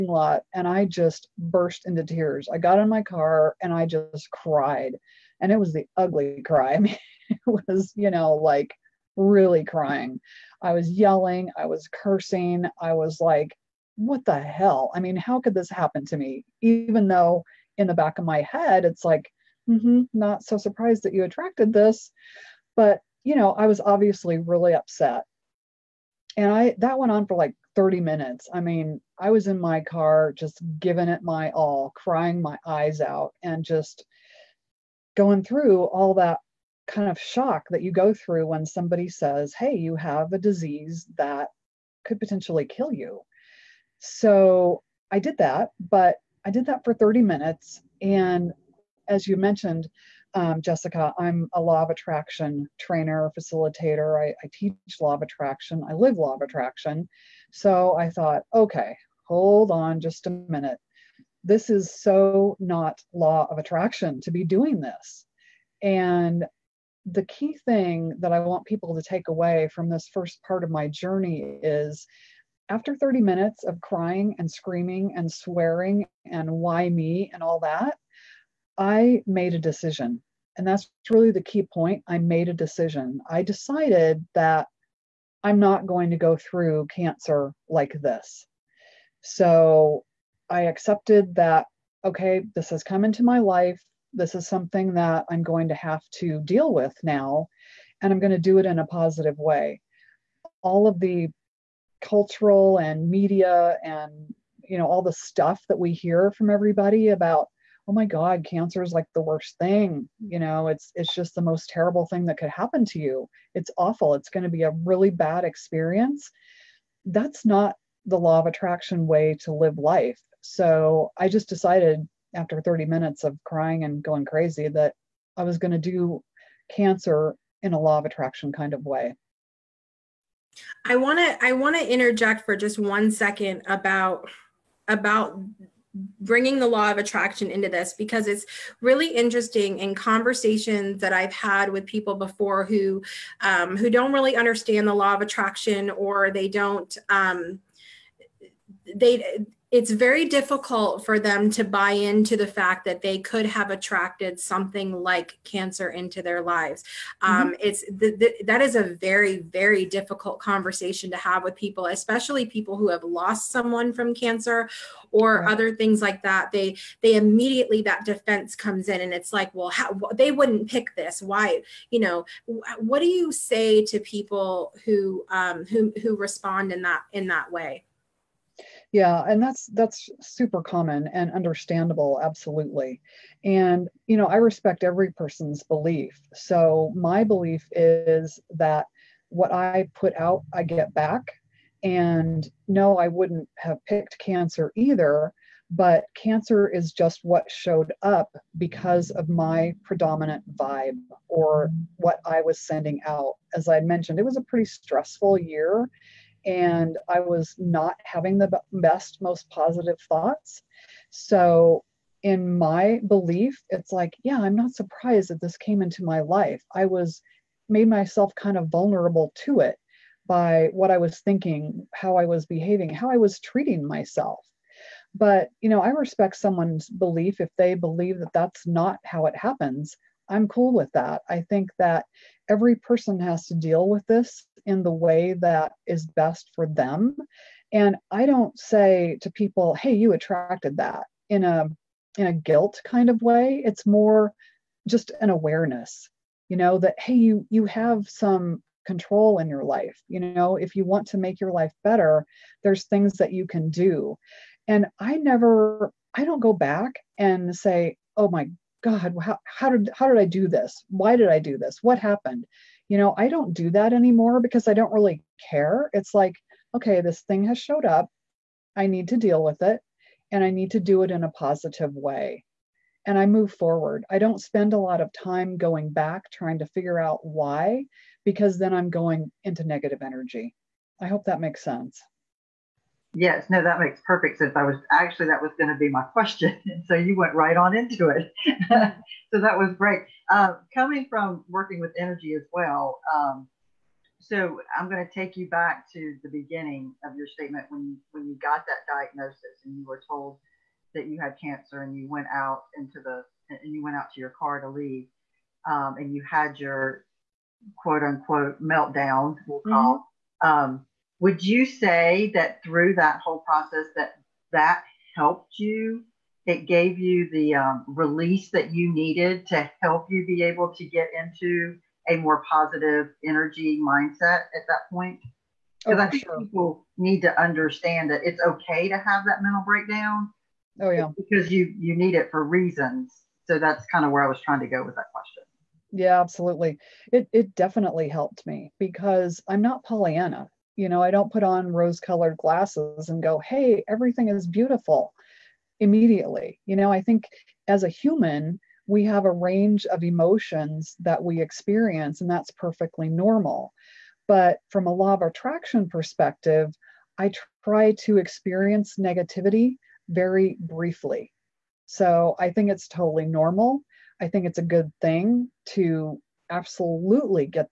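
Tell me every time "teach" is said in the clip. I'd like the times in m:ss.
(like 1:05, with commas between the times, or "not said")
0:54.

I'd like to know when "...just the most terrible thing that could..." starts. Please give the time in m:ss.
1:51.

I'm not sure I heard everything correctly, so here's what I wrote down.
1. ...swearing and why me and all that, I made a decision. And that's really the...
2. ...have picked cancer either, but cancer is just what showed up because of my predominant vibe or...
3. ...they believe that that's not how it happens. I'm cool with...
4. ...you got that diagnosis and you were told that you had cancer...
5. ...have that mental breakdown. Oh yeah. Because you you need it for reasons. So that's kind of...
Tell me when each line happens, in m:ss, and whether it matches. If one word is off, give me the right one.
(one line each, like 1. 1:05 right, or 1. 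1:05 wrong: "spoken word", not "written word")
1. 1:15 right
2. 3:13 right
3. 3:47 right
4. 4:58 right
5. 5:28 right.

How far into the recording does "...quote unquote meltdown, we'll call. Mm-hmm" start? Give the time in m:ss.
5:07.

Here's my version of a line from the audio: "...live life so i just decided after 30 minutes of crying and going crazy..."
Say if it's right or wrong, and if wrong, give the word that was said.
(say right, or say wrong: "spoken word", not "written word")
right.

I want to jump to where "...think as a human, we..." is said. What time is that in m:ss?
5:47.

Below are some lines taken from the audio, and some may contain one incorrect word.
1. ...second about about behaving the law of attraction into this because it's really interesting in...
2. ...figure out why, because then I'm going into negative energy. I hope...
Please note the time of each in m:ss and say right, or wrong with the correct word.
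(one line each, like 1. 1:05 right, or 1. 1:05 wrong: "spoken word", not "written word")
1. 2:13 wrong: "bringing", not "behaving"
2. 4:36 right.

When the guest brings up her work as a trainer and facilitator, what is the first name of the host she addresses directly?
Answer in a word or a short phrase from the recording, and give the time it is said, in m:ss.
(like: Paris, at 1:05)
Jessica, at 0:50.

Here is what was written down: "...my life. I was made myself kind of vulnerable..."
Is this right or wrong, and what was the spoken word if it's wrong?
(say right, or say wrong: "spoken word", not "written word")
right.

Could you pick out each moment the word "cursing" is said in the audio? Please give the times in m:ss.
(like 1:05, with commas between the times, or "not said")
0:11.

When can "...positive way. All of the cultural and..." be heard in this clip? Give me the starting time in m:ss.
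1:38.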